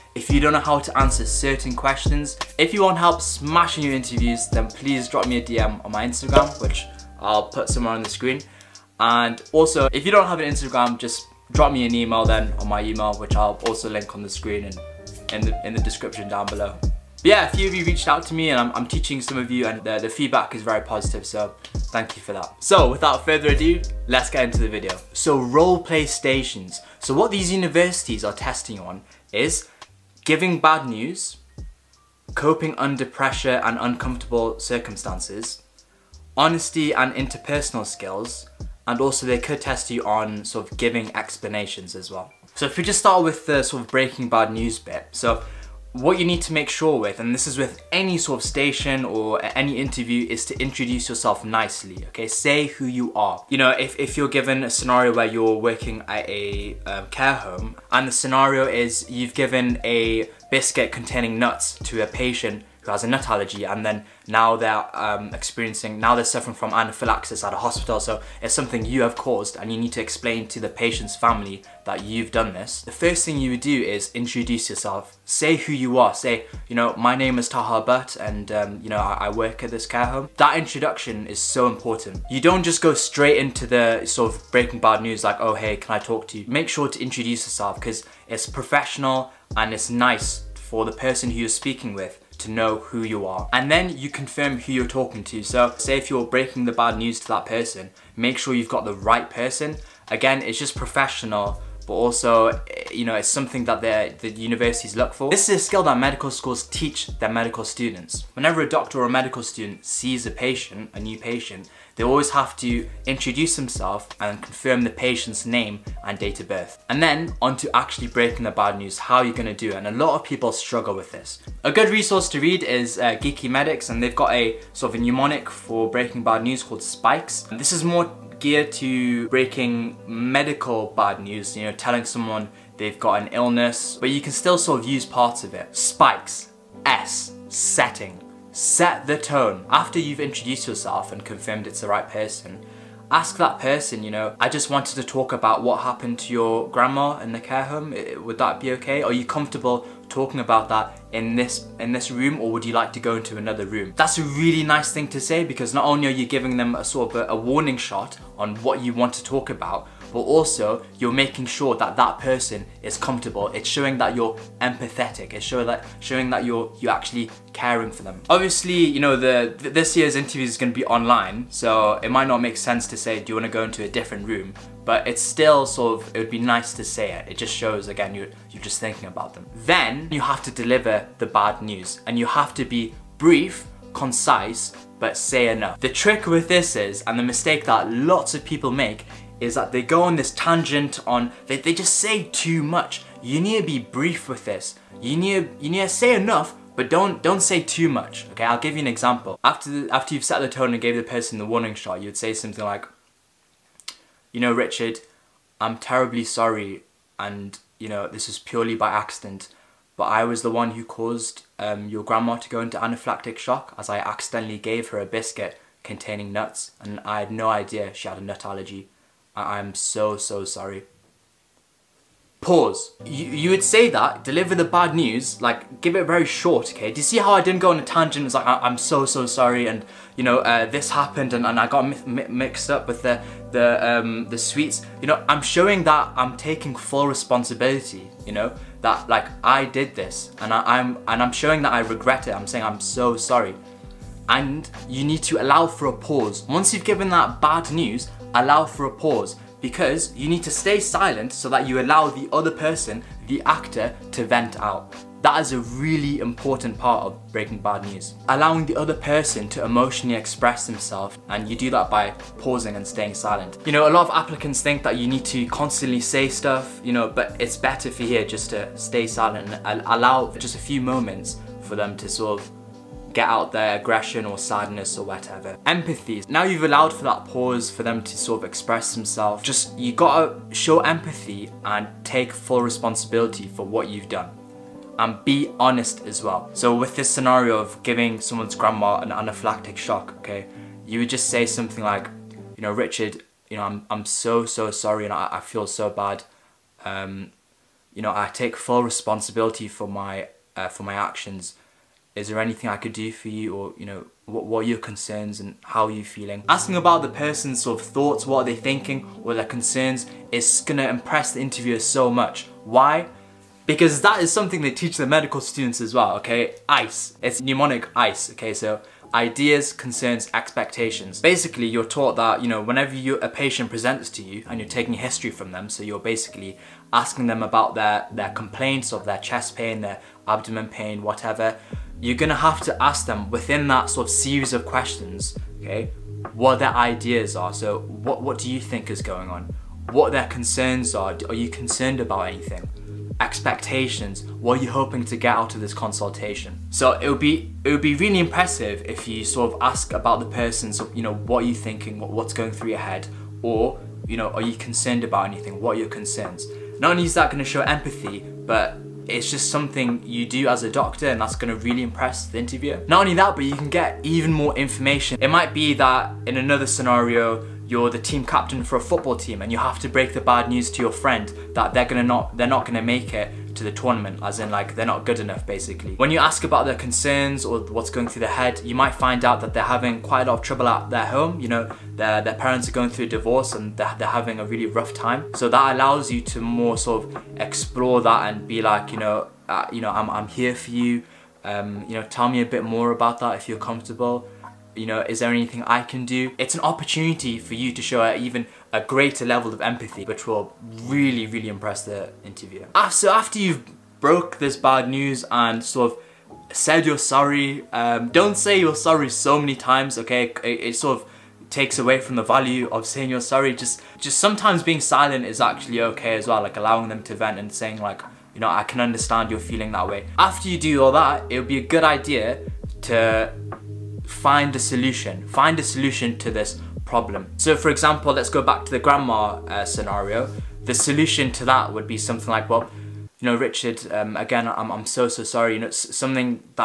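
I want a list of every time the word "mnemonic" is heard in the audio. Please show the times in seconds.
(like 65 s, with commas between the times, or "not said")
125 s, 317 s.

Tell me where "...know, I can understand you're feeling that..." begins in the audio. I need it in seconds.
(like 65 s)
418 s.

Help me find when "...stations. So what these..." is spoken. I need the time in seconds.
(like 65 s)
26 s.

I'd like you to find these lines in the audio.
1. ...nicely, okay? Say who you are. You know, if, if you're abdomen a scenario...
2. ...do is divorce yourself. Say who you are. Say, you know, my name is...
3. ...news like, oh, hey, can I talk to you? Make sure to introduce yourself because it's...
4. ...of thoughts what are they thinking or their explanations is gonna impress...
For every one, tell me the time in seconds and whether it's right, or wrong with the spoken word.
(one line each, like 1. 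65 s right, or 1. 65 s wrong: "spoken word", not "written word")
1. 51 s wrong: "given", not "abdomen"
2. 73 s wrong: "introduce", not "divorce"
3. 85 s right
4. 307 s wrong: "concerns", not "explanations".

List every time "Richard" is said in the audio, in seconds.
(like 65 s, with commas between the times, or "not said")
204 s, 292 s, 433 s.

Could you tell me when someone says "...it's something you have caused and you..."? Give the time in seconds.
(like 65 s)
68 s.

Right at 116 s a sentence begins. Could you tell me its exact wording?
And then on to actually breaking the bad news, how you're gonna do it.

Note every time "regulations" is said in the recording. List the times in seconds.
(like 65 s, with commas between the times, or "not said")
not said.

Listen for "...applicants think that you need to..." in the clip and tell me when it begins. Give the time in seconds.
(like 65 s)
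264 s.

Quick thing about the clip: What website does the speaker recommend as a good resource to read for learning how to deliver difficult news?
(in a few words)
Geeky Medics.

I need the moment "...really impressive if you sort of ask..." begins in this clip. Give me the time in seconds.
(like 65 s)
347 s.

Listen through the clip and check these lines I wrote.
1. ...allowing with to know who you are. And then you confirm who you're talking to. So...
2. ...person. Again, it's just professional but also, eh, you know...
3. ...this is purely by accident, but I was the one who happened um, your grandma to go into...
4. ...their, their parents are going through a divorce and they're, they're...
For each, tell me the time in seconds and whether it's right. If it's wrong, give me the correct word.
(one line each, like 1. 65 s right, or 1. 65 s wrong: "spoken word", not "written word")
1. 91 s wrong: "speaking", not "allowing"
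2. 99 s right
3. 208 s wrong: "caused", not "happened"
4. 381 s right.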